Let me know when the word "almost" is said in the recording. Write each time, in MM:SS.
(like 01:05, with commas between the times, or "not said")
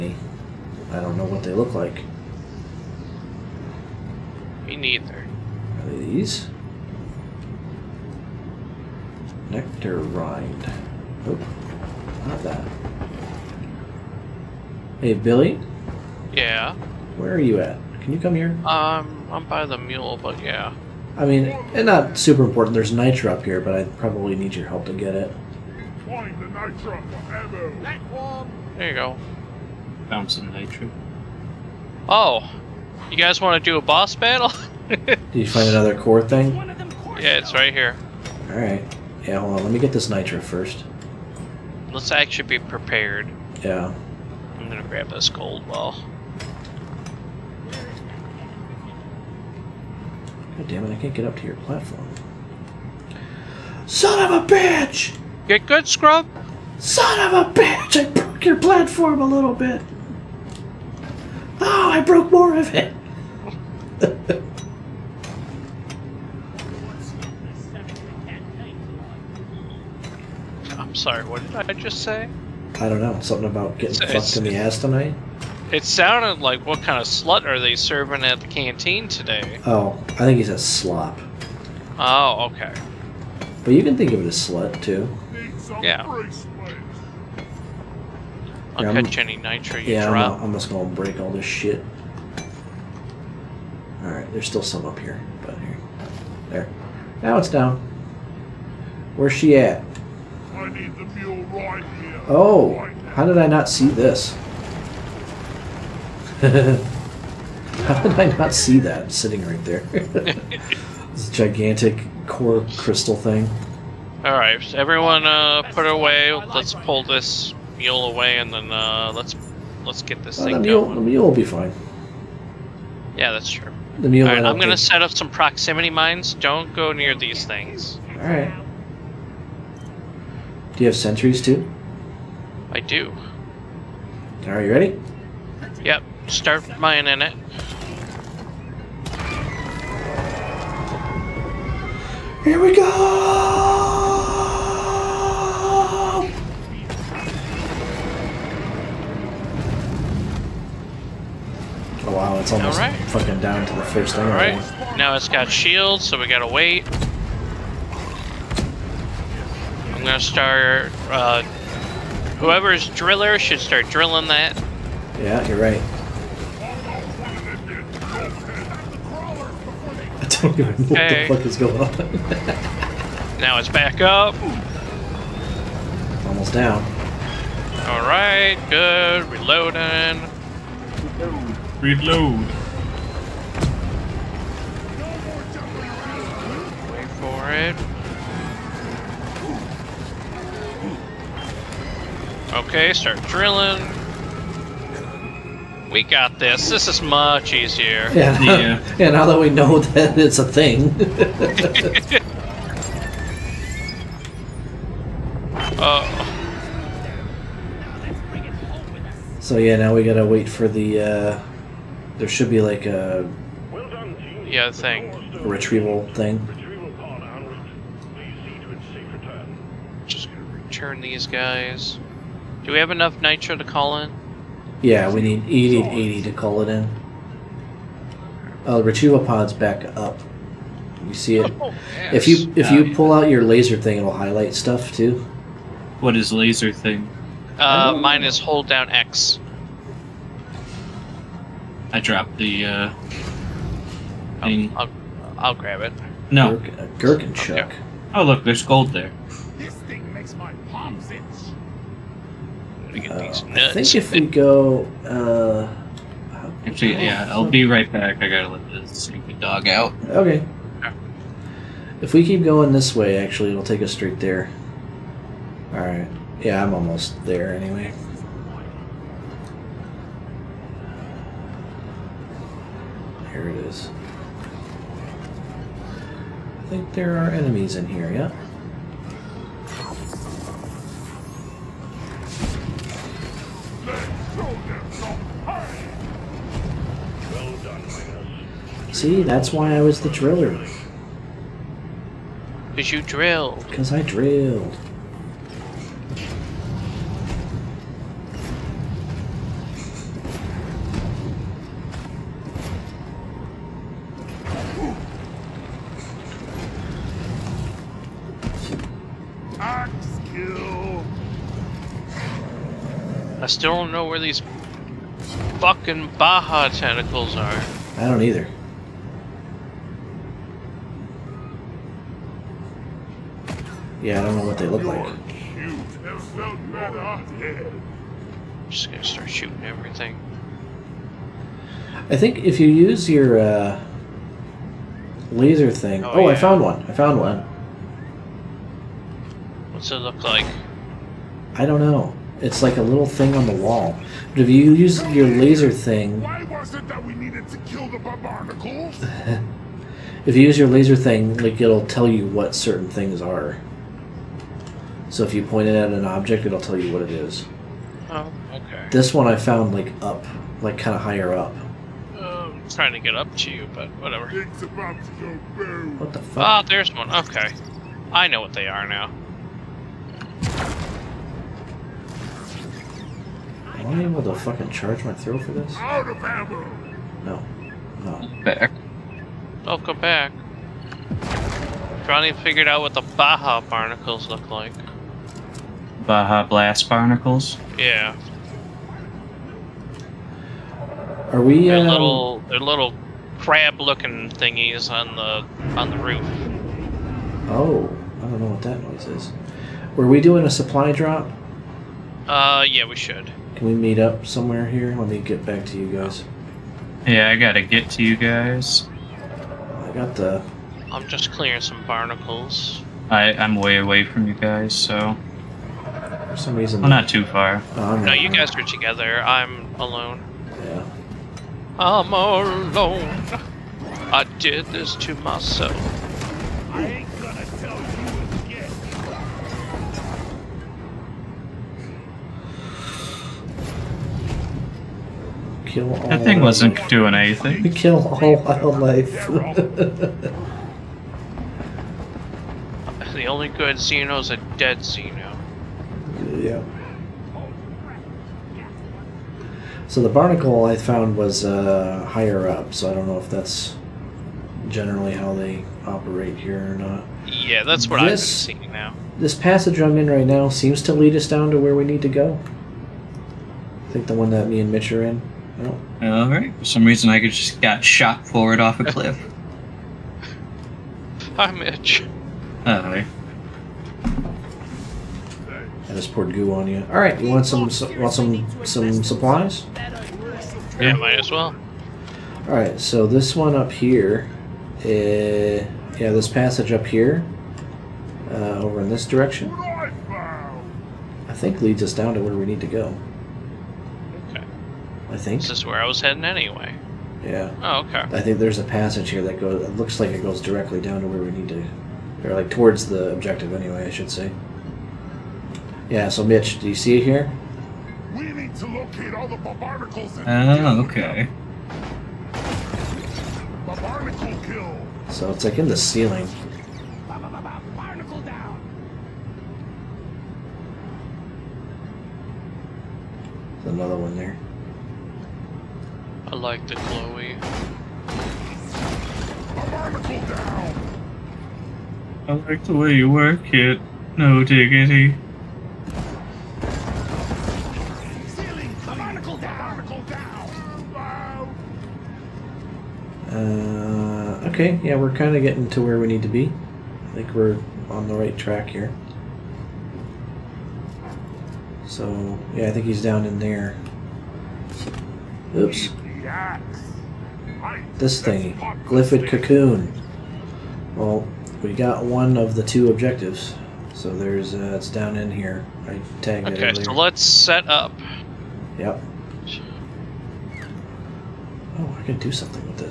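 02:32, 02:56, 04:26.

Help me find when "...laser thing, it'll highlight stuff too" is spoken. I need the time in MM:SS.
03:53.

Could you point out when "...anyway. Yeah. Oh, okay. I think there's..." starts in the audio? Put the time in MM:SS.
08:16.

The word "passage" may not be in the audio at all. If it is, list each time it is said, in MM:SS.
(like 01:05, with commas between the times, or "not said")
07:39, 08:06, 08:18.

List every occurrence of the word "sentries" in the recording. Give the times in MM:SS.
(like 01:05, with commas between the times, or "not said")
02:10.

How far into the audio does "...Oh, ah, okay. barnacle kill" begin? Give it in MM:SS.
08:30.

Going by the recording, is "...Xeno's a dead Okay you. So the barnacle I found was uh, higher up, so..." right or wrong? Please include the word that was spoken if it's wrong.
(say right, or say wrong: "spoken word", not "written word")
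wrong: "Xeno", not "Okay".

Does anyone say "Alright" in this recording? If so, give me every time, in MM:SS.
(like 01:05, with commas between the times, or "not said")
00:38, 01:34, 01:54, 02:08, 02:34, 04:25.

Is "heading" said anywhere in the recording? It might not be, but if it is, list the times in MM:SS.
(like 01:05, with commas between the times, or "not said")
08:16.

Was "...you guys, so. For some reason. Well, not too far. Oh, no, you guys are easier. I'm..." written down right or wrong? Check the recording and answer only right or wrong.
wrong.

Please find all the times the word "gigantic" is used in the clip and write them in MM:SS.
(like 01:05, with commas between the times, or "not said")
01:51.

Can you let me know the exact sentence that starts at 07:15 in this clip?
Kill all that thing wasn't doing anything.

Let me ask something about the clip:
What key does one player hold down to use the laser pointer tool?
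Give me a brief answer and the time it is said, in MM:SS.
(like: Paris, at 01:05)
X, at 03:58.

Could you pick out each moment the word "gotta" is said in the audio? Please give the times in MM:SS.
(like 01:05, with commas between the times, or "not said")
02:36, 03:30, 04:18, 06:47.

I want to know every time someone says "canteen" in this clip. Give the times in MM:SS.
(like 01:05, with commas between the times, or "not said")
01:18.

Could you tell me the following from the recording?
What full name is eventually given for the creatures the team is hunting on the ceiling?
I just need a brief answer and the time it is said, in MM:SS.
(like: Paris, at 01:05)
Blast barnacles, at 06:26.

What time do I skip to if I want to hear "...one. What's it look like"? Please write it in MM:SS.
05:37.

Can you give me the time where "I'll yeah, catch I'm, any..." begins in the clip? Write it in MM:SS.
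01:28.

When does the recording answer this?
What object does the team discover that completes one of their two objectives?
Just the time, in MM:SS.
09:18.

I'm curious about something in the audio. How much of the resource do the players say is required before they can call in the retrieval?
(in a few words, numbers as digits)
80.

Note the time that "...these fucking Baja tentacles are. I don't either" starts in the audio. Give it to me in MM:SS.
05:14.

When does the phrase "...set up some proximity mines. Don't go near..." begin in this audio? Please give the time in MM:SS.
02:04.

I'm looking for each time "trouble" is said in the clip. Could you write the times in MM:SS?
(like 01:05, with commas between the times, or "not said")
not said.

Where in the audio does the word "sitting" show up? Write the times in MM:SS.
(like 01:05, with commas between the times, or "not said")
01:49.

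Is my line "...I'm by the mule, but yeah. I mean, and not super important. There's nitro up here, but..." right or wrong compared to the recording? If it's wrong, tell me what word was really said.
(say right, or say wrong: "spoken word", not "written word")
right.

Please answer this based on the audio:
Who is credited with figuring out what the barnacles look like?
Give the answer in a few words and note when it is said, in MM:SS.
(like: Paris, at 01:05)
Johnny, at 06:22.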